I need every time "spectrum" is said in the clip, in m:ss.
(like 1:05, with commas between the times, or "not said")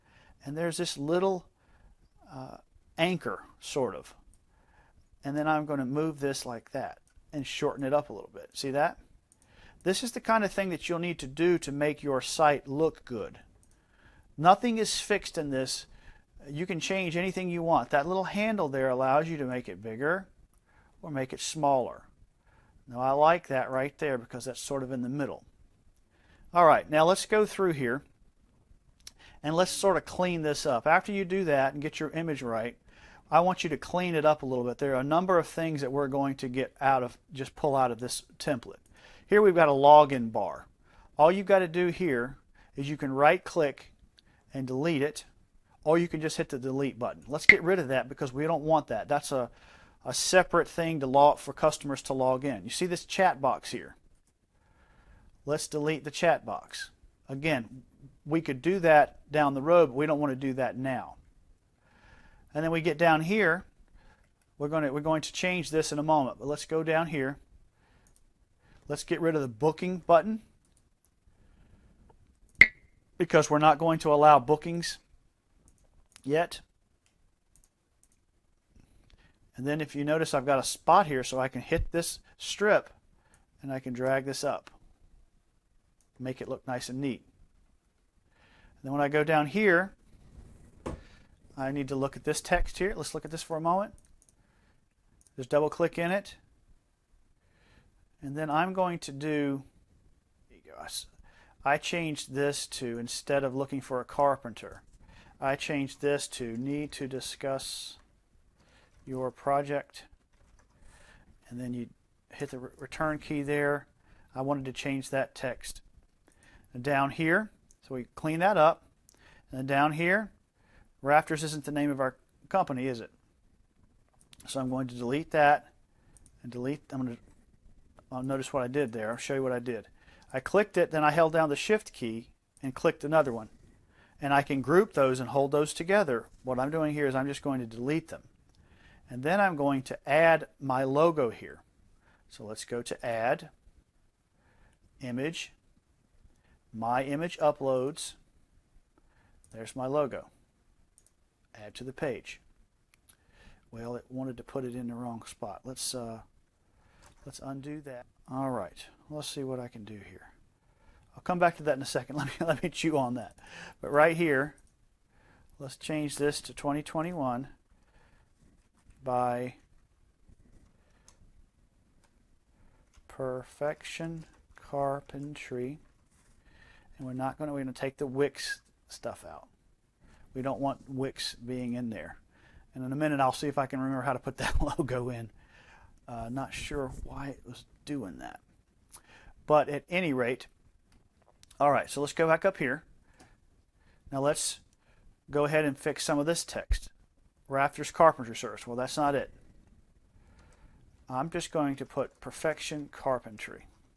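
not said.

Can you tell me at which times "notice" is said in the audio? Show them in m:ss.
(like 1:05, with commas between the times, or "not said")
1:20, 2:08.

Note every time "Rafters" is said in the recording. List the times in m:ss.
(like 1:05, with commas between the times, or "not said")
2:01, 3:17.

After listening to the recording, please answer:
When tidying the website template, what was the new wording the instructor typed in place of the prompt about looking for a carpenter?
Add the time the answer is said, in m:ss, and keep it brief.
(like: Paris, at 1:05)
Need to discuss your project, at 1:46.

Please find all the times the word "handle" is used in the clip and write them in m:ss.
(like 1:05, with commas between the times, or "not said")
0:18.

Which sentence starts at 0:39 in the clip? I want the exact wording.
Here we've got a login bar.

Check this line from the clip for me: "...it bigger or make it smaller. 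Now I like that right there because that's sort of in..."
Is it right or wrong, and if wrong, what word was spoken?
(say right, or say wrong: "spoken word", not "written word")
right.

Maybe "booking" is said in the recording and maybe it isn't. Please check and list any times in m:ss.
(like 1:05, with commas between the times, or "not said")
1:09, 1:14.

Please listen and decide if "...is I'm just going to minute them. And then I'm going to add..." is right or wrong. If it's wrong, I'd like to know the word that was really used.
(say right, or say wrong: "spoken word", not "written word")
wrong: "delete", not "minute".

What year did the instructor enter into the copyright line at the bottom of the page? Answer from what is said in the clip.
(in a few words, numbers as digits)
2021.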